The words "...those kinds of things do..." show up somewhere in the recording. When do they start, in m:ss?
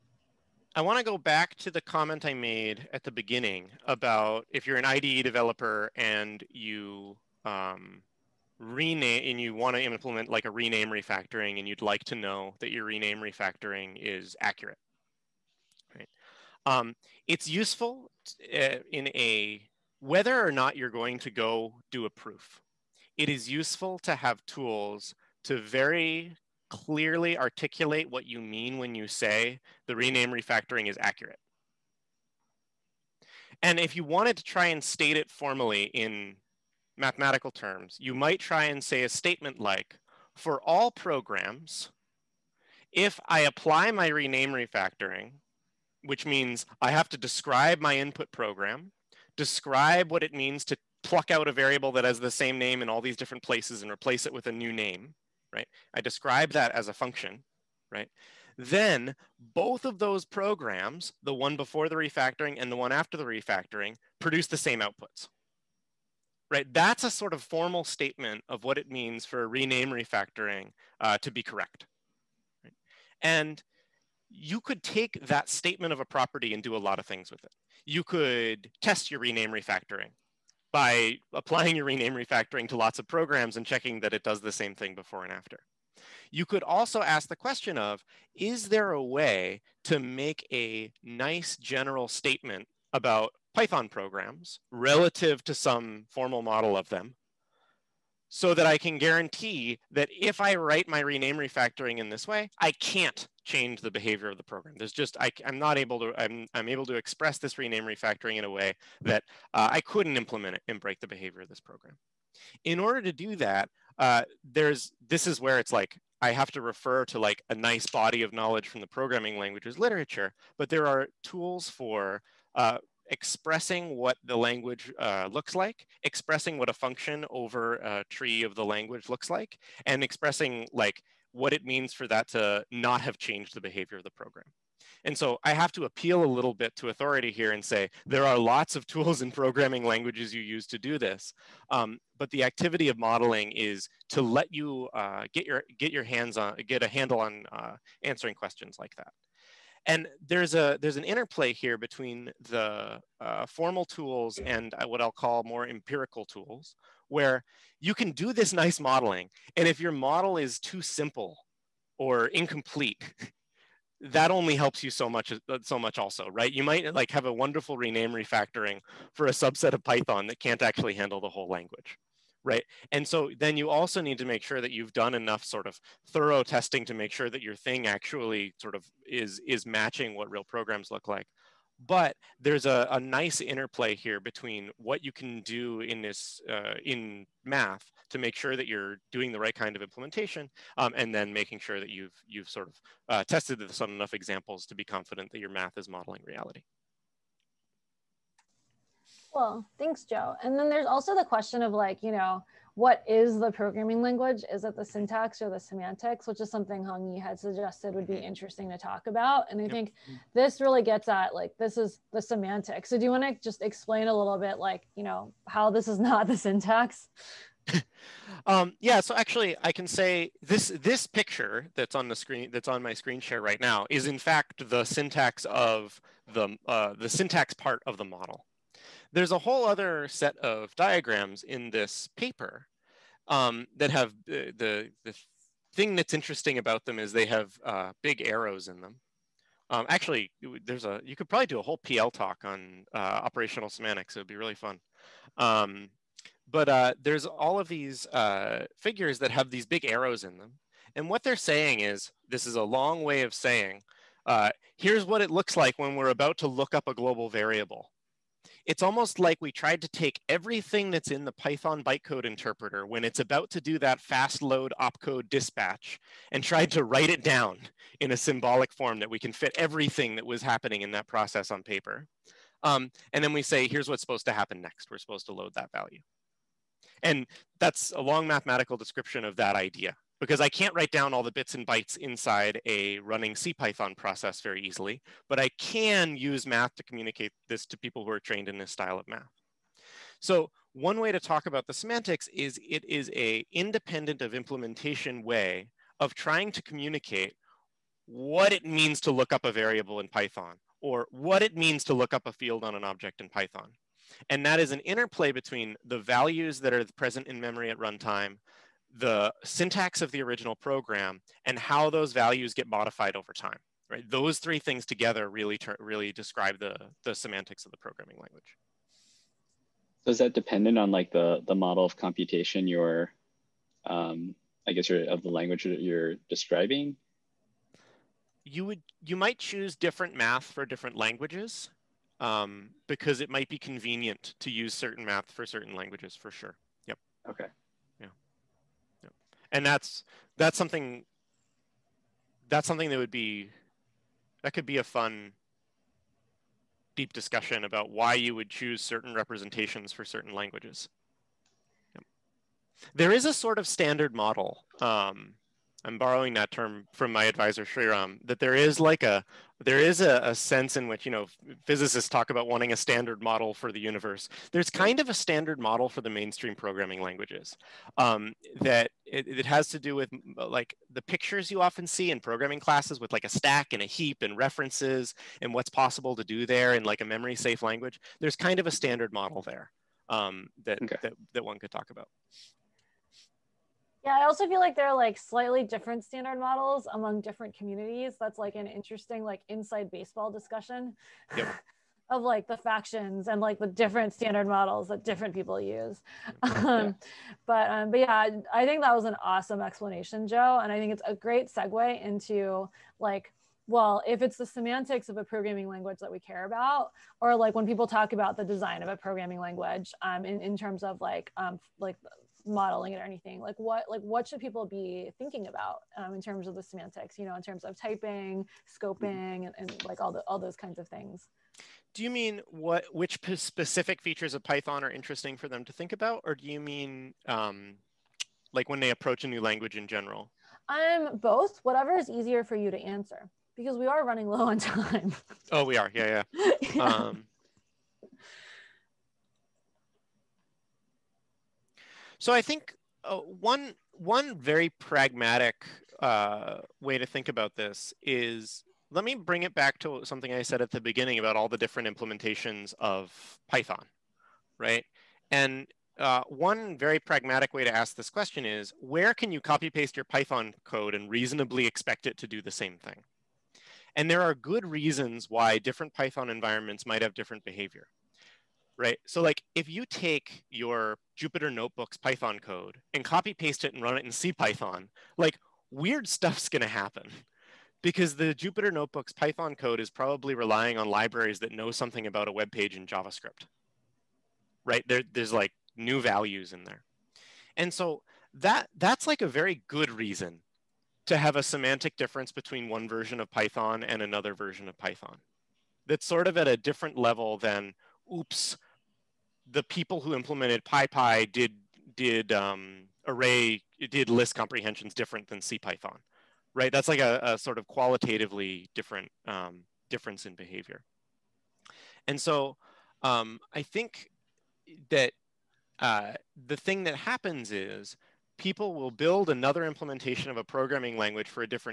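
7:00.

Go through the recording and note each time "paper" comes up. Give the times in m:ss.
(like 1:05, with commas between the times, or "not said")
3:52, 4:31.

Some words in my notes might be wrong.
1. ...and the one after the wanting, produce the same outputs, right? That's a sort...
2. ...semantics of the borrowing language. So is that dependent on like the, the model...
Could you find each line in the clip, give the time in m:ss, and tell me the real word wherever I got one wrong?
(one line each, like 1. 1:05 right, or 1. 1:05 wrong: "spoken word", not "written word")
1. 1:02 wrong: "refactoring", not "wanting"
2. 5:17 wrong: "programming", not "borrowing".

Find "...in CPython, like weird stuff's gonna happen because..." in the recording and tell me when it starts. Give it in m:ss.
7:54.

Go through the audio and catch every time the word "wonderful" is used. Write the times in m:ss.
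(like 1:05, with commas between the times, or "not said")
2:47.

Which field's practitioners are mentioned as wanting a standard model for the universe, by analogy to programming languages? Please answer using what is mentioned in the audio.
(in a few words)
physicists.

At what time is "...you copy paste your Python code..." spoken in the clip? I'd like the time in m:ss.
7:39.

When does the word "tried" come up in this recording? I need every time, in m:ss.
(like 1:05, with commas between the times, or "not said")
4:19, 4:26.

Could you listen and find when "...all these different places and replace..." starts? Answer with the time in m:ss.
0:52.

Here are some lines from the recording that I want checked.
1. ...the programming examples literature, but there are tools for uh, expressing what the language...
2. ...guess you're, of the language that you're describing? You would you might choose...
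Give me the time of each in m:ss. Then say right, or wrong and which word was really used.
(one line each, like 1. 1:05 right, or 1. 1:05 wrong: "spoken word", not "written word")
1. 1:58 wrong: "languages", not "examples"
2. 5:24 right.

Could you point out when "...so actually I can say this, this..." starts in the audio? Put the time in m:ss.
3:39.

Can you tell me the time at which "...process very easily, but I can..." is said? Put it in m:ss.
4:43.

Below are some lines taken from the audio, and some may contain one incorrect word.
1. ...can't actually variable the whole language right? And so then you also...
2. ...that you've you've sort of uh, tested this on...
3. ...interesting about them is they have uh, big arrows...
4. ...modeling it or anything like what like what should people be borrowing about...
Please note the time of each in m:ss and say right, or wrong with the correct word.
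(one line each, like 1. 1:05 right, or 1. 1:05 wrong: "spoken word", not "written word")
1. 2:50 wrong: "handle", not "variable"
2. 3:11 right
3. 3:56 right
4. 6:52 wrong: "thinking", not "borrowing".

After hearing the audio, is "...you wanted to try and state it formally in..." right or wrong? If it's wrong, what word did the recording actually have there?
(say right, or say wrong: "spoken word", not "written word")
right.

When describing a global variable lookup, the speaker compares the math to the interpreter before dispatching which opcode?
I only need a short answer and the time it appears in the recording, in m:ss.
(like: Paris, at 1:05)
fast load, at 4:23.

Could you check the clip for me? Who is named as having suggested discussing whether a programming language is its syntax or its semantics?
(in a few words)
Hongyi Yi.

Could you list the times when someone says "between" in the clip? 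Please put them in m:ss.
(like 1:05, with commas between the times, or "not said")
2:31, 3:04, 5:05, 8:12.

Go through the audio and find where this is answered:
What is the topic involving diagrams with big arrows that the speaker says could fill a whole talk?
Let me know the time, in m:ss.
4:02.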